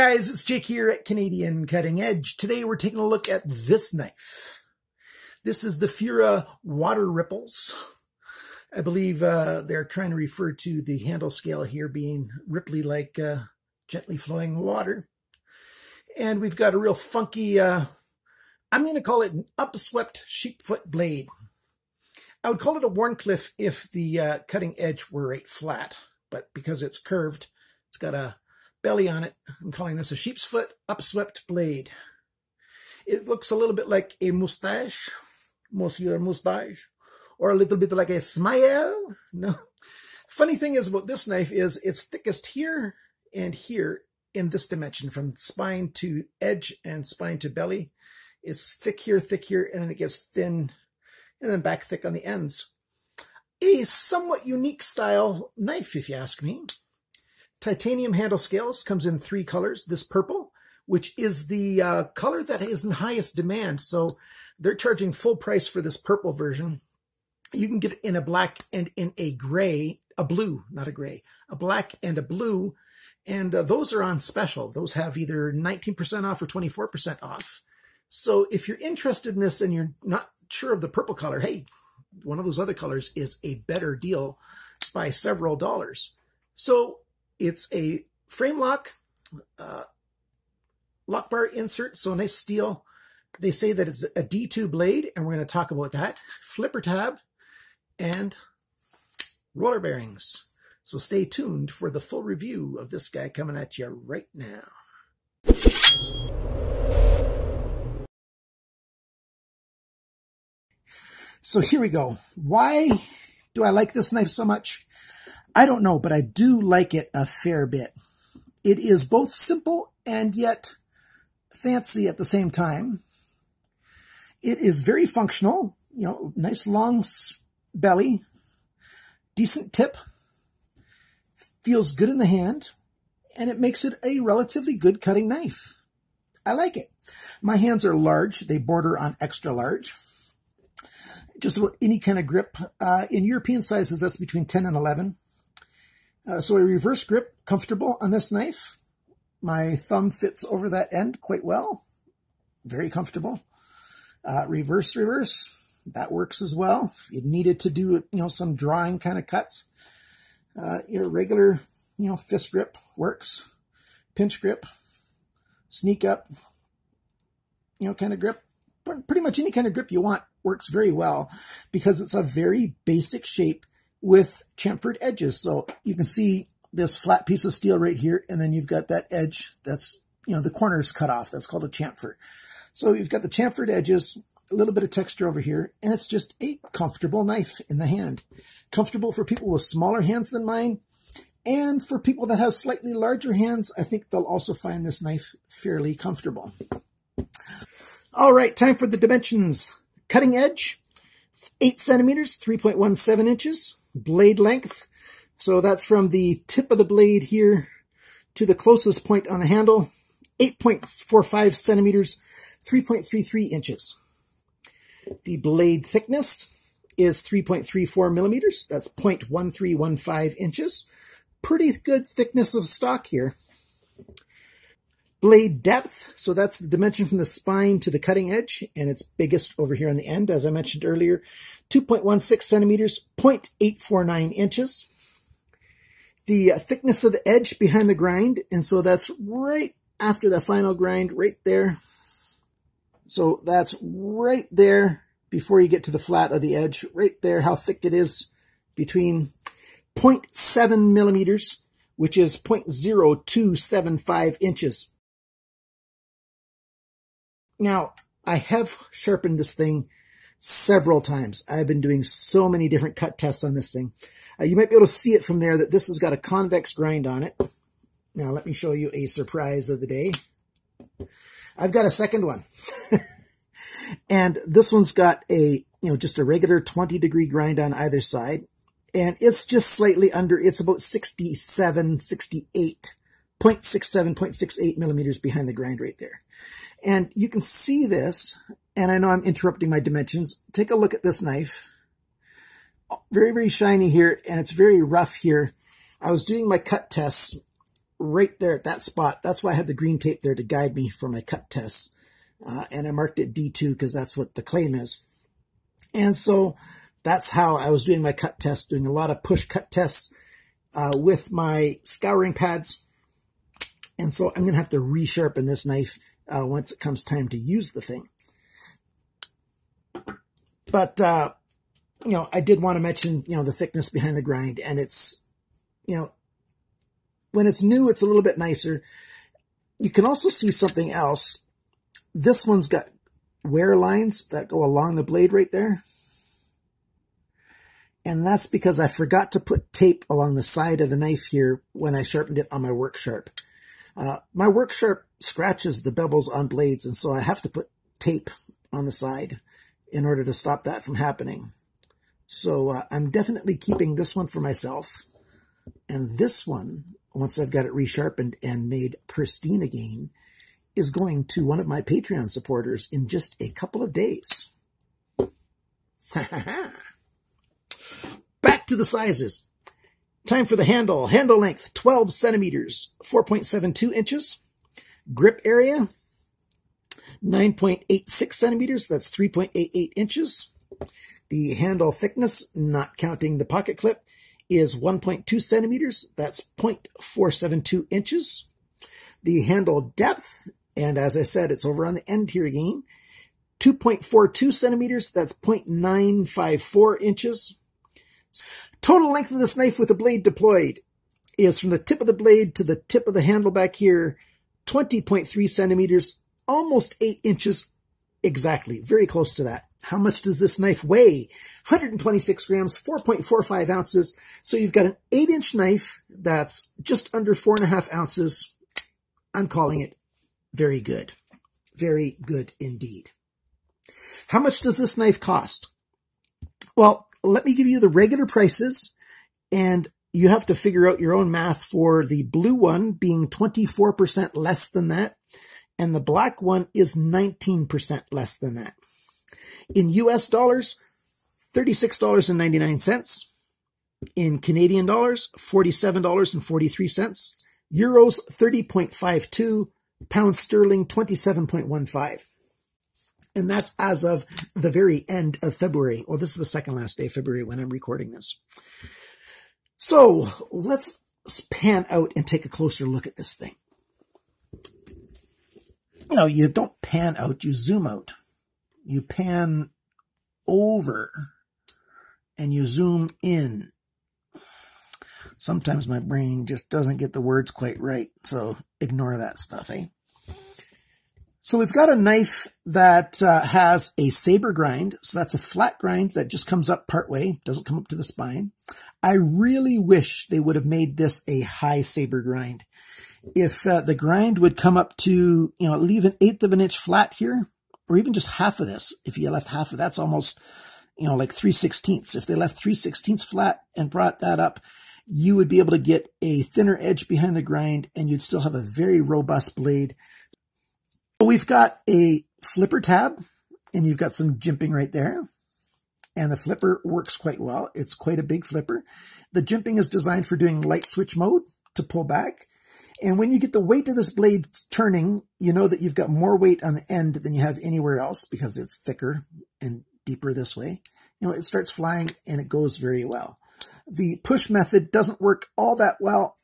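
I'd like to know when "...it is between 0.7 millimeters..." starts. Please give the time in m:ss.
4:07.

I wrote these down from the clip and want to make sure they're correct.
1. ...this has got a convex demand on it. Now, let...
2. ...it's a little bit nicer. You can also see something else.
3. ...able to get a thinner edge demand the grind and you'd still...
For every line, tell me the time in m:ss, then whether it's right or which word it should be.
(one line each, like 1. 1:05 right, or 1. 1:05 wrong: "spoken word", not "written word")
1. 4:25 wrong: "grind", not "demand"
2. 5:27 right
3. 8:25 wrong: "behind", not "demand".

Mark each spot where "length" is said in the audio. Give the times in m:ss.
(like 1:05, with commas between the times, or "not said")
3:24, 6:11, 6:39.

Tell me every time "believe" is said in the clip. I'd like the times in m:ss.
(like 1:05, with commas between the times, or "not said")
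0:08.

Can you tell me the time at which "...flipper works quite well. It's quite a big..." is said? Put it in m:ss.
8:36.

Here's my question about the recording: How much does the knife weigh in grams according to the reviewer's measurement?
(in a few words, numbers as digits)
126 grams.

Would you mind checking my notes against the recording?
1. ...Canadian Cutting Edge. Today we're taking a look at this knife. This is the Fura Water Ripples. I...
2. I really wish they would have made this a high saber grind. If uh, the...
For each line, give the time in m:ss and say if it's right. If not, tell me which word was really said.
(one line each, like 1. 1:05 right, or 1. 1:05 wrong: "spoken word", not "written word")
1. 0:01 right
2. 8:09 right.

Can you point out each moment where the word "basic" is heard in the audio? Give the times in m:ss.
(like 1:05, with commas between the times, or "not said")
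2:52.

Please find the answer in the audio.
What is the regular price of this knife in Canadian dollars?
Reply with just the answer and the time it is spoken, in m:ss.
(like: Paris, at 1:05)
$47.43, at 7:25.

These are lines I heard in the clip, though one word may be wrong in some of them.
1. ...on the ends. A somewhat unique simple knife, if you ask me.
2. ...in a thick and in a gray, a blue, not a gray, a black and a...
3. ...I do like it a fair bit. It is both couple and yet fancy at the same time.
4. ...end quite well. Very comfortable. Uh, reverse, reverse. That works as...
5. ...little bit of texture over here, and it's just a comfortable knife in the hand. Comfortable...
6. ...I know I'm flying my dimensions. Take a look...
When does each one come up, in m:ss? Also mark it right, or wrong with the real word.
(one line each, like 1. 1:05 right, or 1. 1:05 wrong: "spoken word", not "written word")
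1. 0:52 wrong: "style", not "simple"
2. 1:08 wrong: "black", not "thick"
3. 1:56 wrong: "simple", not "couple"
4. 2:30 right
5. 3:04 right
6. 4:48 wrong: "interrupting", not "flying".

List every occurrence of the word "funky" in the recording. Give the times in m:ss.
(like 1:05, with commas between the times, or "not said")
0:16.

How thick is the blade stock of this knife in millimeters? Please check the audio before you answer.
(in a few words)
3.34 millimeters.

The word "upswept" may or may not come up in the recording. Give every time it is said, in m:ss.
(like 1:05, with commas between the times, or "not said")
0:19, 0:30.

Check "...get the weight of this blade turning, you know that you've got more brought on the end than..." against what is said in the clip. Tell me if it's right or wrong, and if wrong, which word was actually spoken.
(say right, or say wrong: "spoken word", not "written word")
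wrong: "weight", not "brought".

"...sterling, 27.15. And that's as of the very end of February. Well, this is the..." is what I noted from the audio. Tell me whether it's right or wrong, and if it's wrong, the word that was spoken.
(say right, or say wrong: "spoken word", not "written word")
right.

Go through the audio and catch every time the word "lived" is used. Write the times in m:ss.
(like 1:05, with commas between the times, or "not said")
not said.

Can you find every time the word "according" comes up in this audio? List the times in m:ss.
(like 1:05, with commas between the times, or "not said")
not said.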